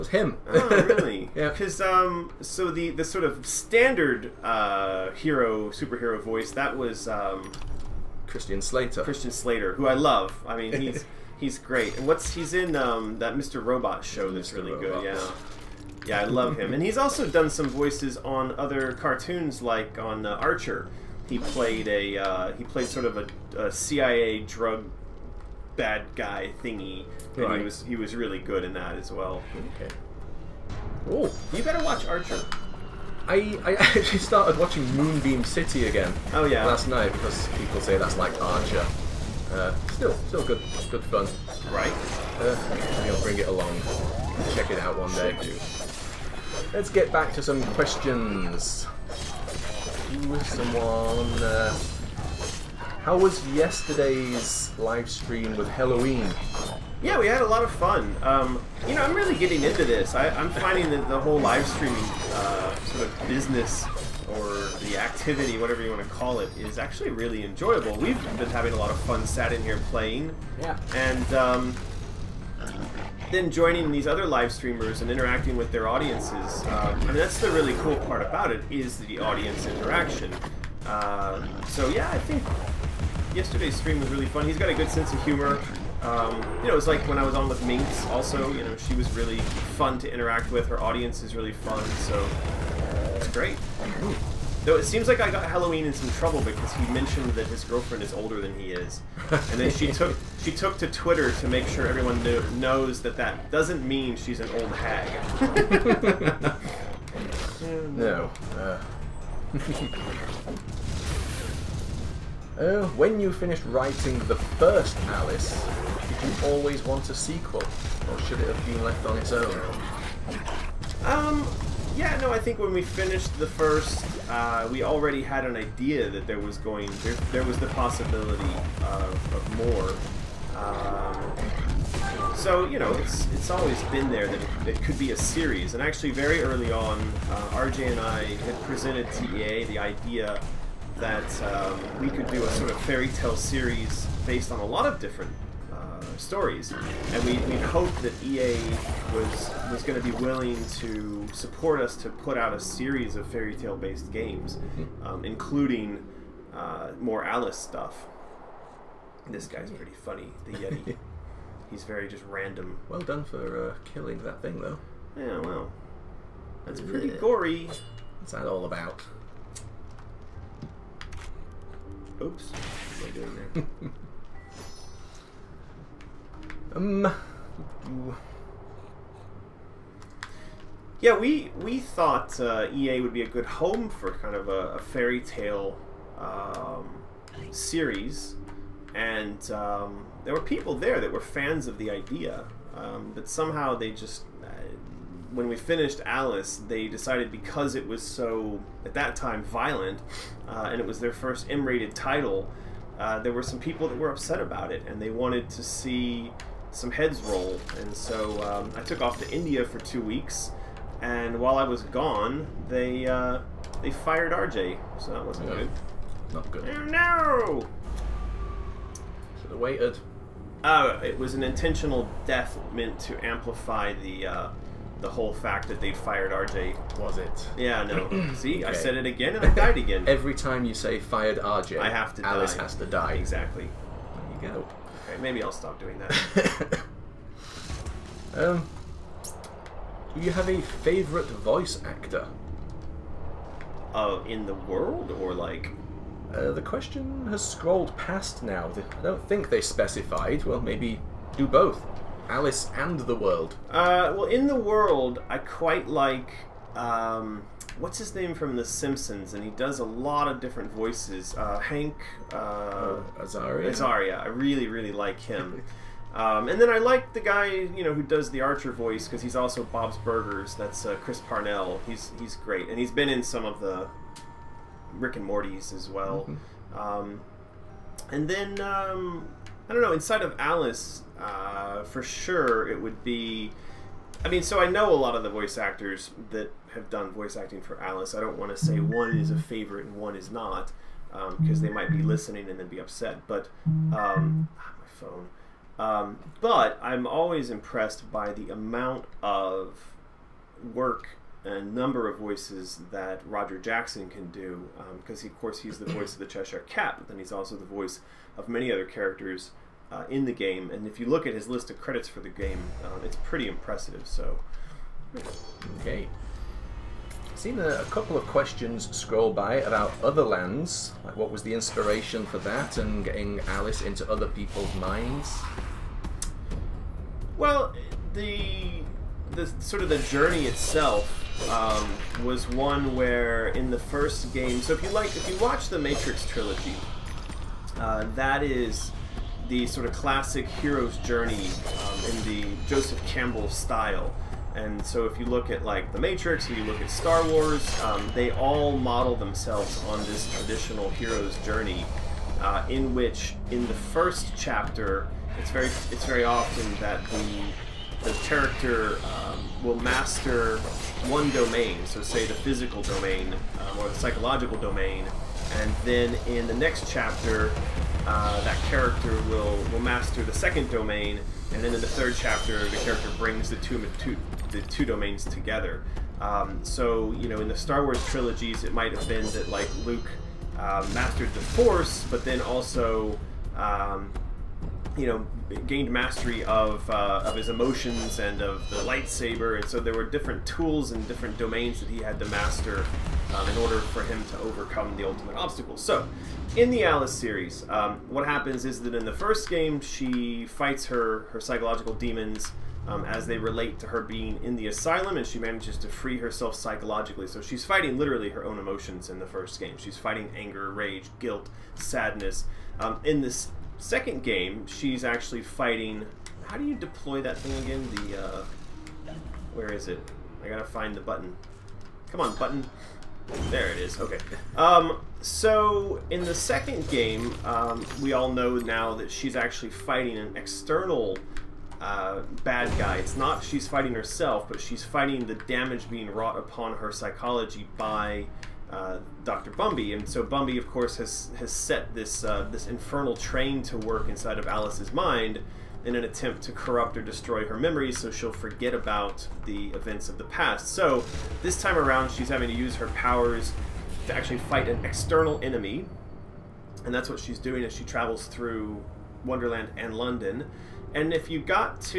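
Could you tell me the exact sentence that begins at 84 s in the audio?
He's got a good sense of humor.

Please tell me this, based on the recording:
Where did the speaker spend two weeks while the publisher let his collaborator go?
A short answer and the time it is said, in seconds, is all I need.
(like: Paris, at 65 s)
India, at 209 s.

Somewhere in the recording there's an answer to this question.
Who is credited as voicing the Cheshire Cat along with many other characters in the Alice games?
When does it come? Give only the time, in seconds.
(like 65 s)
303 s.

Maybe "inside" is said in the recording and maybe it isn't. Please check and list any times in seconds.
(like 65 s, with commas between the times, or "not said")
279 s, 444 s.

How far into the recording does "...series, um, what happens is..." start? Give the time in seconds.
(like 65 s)
397 s.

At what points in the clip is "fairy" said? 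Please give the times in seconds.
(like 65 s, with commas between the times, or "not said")
142 s, 153 s, 184 s.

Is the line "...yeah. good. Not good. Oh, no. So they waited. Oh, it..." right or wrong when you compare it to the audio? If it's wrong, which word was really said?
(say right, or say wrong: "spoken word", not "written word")
right.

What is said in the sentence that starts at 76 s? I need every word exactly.
I um, mean, that's the really cool part about it is the audience interaction.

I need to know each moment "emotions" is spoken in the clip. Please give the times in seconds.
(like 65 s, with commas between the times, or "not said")
387 s, 408 s.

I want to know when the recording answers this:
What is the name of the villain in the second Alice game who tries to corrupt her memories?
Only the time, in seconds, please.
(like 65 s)
439 s.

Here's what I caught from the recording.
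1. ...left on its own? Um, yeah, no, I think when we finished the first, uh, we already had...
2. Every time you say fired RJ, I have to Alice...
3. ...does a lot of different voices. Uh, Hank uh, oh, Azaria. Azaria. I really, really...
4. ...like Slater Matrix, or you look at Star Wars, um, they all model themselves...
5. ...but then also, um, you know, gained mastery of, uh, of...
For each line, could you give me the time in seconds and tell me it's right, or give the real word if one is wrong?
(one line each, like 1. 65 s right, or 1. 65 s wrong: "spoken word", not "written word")
1. 118 s right
2. 230 s right
3. 259 s right
4. 345 s wrong: "The", not "Slater"
5. 382 s right.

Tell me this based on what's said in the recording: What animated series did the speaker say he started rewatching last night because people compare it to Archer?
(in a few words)
Moonbeam City.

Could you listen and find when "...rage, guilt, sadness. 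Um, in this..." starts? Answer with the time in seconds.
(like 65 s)
410 s.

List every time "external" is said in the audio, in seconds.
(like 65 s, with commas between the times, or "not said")
430 s, 454 s.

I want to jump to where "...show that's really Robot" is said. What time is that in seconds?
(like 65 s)
14 s.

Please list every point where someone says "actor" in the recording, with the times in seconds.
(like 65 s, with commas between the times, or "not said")
241 s, 285 s.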